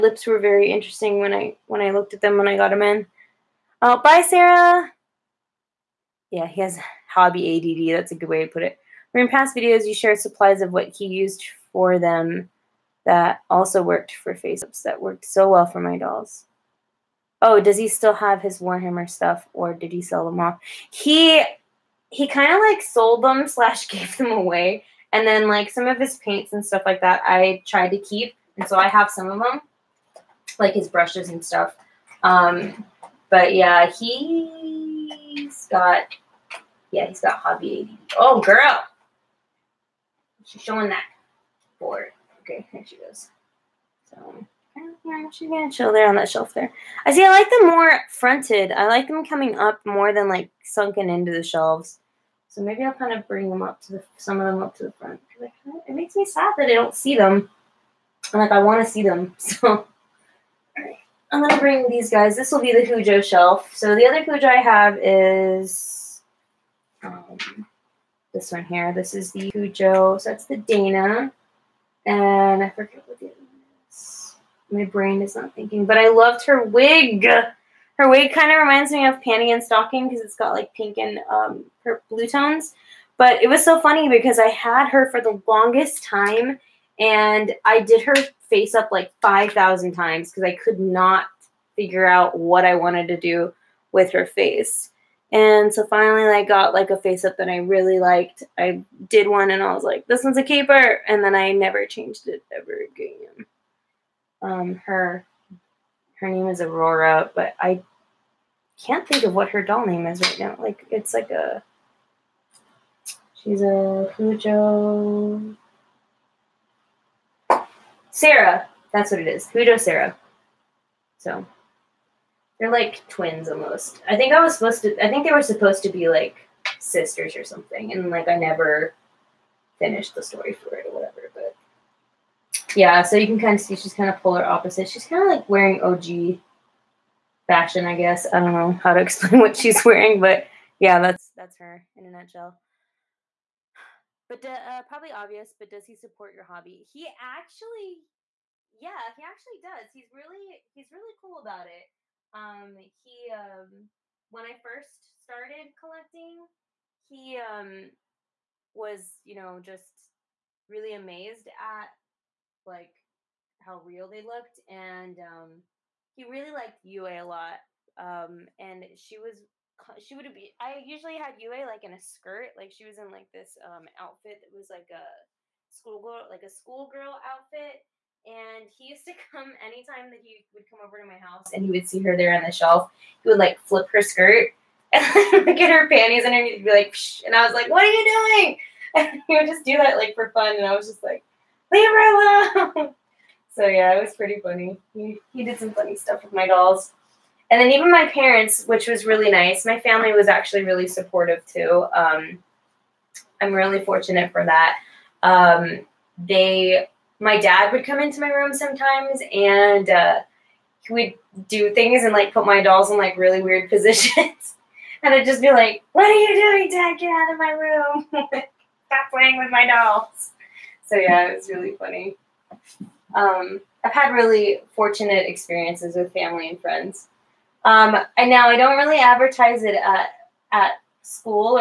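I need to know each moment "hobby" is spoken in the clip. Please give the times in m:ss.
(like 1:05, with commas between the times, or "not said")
0:07, 0:37, 2:26.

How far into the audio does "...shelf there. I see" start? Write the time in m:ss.
0:46.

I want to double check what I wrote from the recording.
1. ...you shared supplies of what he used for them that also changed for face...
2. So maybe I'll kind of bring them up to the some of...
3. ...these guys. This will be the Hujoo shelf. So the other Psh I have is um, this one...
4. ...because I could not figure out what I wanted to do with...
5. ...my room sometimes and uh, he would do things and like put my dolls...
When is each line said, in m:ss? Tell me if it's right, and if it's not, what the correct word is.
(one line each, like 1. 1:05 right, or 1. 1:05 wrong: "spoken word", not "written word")
1. 0:09 wrong: "worked", not "changed"
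2. 0:52 right
3. 1:01 wrong: "Hujoo", not "Psh"
4. 1:30 right
5. 3:28 right.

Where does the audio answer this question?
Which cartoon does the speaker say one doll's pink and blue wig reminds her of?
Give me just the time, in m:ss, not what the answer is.
1:19.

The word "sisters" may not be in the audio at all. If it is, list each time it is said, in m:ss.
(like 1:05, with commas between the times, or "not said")
2:06.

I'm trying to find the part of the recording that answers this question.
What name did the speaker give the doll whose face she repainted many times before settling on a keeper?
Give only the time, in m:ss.
1:46.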